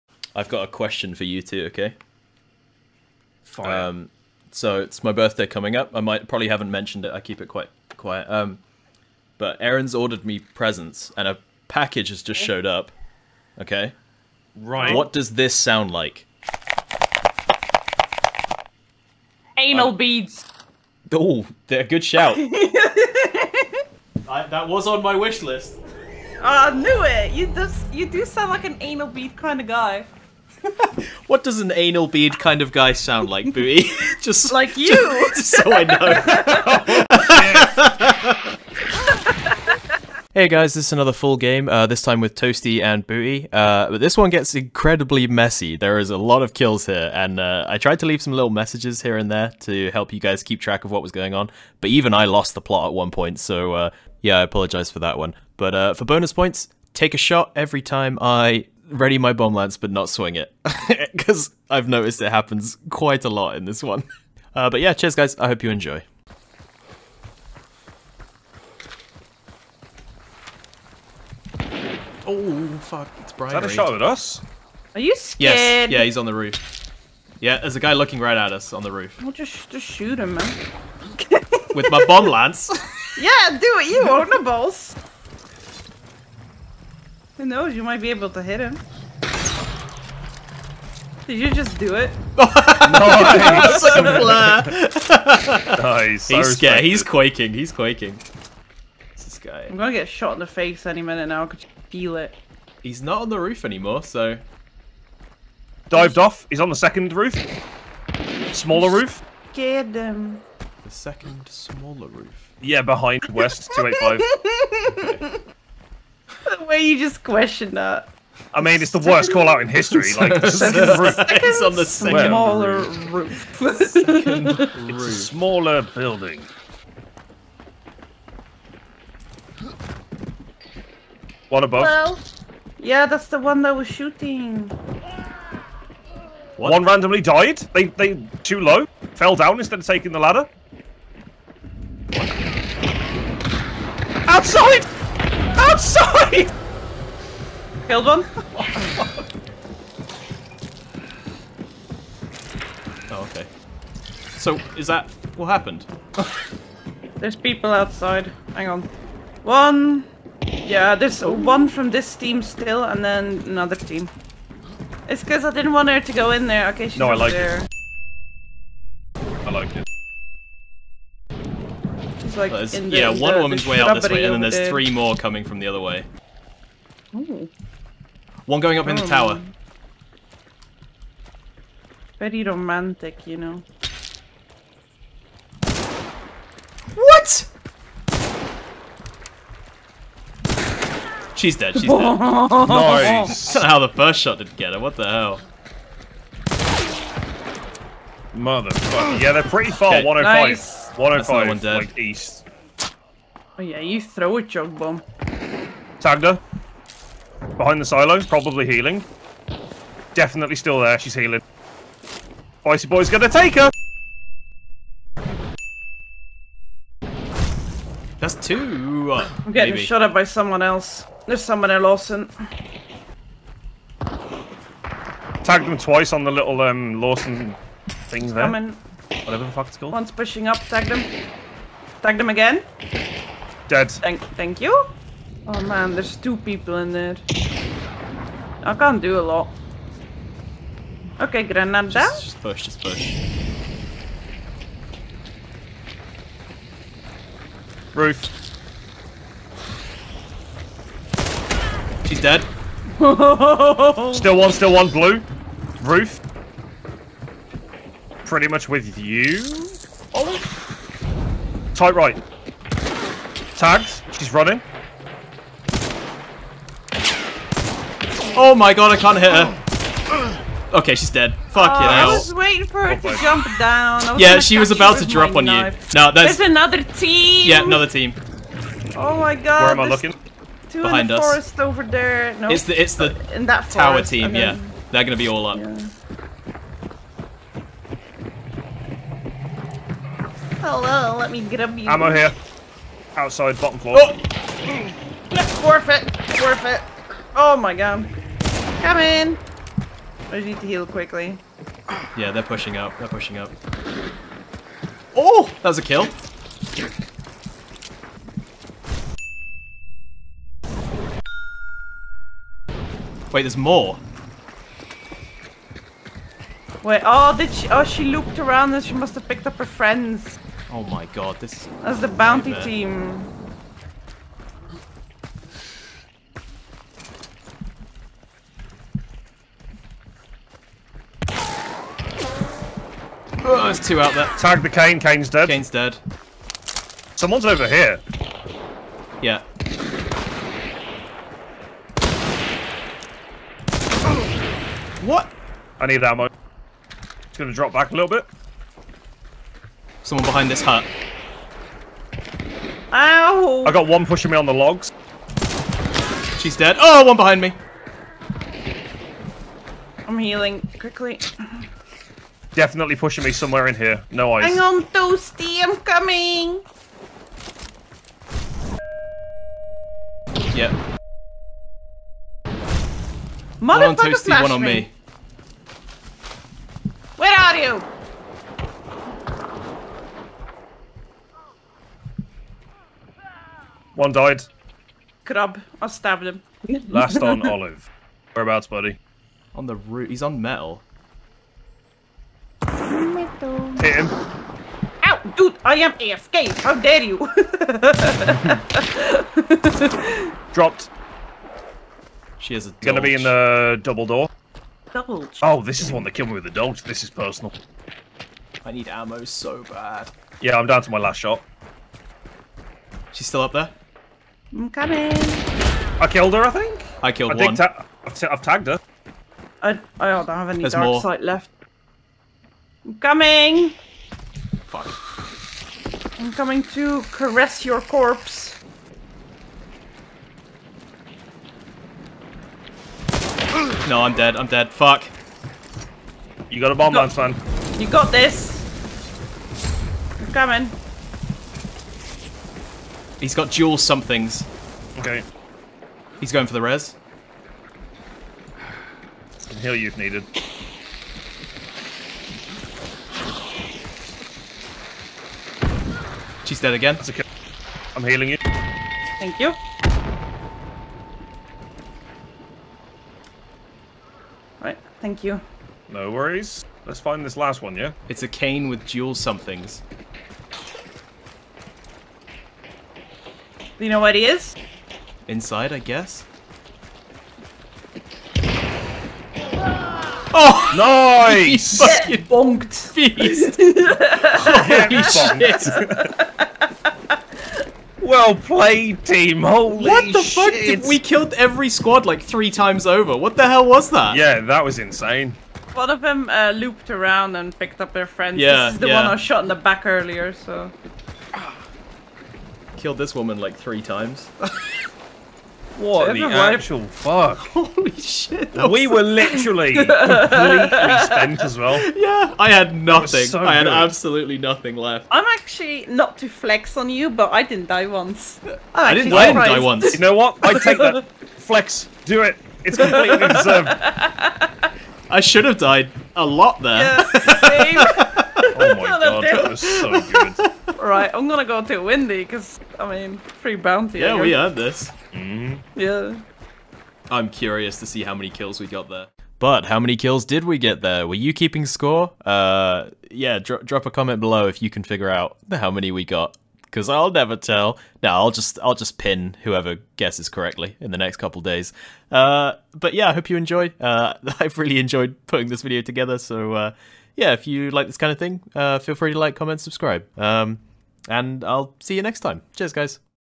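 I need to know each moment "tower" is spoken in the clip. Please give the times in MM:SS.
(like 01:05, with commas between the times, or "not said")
02:59, 04:43.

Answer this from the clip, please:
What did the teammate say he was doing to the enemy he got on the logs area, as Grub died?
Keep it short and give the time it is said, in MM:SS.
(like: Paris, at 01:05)
Stabbed him, at 06:25.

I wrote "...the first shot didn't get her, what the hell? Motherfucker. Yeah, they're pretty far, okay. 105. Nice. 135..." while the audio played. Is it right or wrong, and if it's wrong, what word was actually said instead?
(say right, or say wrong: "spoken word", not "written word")
wrong: "105", not "135".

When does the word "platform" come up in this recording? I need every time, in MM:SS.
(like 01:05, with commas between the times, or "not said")
not said.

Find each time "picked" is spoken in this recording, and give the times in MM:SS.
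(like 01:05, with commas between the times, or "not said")
05:19, 08:17.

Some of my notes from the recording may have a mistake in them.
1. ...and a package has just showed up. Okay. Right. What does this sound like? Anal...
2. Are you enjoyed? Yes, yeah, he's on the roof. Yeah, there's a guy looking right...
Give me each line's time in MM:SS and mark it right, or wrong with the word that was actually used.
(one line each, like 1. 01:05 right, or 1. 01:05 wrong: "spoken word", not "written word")
1. 00:11 right
2. 01:14 wrong: "scared", not "enjoyed".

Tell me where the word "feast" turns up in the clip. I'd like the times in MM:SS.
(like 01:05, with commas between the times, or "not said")
08:02.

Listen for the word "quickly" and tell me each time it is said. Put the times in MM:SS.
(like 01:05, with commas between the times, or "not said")
05:00, 06:00.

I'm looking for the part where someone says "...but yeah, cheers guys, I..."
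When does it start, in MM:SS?
01:04.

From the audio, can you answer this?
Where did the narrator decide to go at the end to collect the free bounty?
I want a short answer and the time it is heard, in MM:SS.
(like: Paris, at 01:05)
Windy, at 08:51.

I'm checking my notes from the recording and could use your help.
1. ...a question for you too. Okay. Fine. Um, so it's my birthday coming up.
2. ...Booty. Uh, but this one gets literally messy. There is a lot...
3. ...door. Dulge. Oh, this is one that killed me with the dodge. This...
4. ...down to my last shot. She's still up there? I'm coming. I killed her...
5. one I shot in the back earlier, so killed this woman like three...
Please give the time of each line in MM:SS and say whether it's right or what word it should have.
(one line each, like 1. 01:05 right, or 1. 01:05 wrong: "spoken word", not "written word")
1. 00:00 right
2. 00:43 wrong: "incredibly", not "literally"
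3. 06:44 right
4. 06:50 right
5. 08:19 right.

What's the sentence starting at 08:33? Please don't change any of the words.
So I had absolutely nothing left.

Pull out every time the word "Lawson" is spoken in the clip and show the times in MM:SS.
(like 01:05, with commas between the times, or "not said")
03:41, 03:47.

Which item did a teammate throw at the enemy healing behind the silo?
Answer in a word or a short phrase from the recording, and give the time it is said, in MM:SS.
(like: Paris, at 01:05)
Jug bomb, at 03:24.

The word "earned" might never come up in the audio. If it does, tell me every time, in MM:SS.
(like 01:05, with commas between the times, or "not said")
08:54.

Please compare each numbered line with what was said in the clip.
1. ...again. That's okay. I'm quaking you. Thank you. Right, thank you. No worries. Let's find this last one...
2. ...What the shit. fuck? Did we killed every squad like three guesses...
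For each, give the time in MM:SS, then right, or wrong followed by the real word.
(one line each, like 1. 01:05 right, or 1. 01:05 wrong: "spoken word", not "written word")
1. 07:36 wrong: "healing", not "quaking"
2. 08:09 wrong: "times", not "guesses".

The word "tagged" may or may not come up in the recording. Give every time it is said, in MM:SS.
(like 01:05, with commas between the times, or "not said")
03:25, 03:45, 06:58.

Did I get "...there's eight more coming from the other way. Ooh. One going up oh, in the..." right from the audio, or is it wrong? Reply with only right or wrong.
wrong.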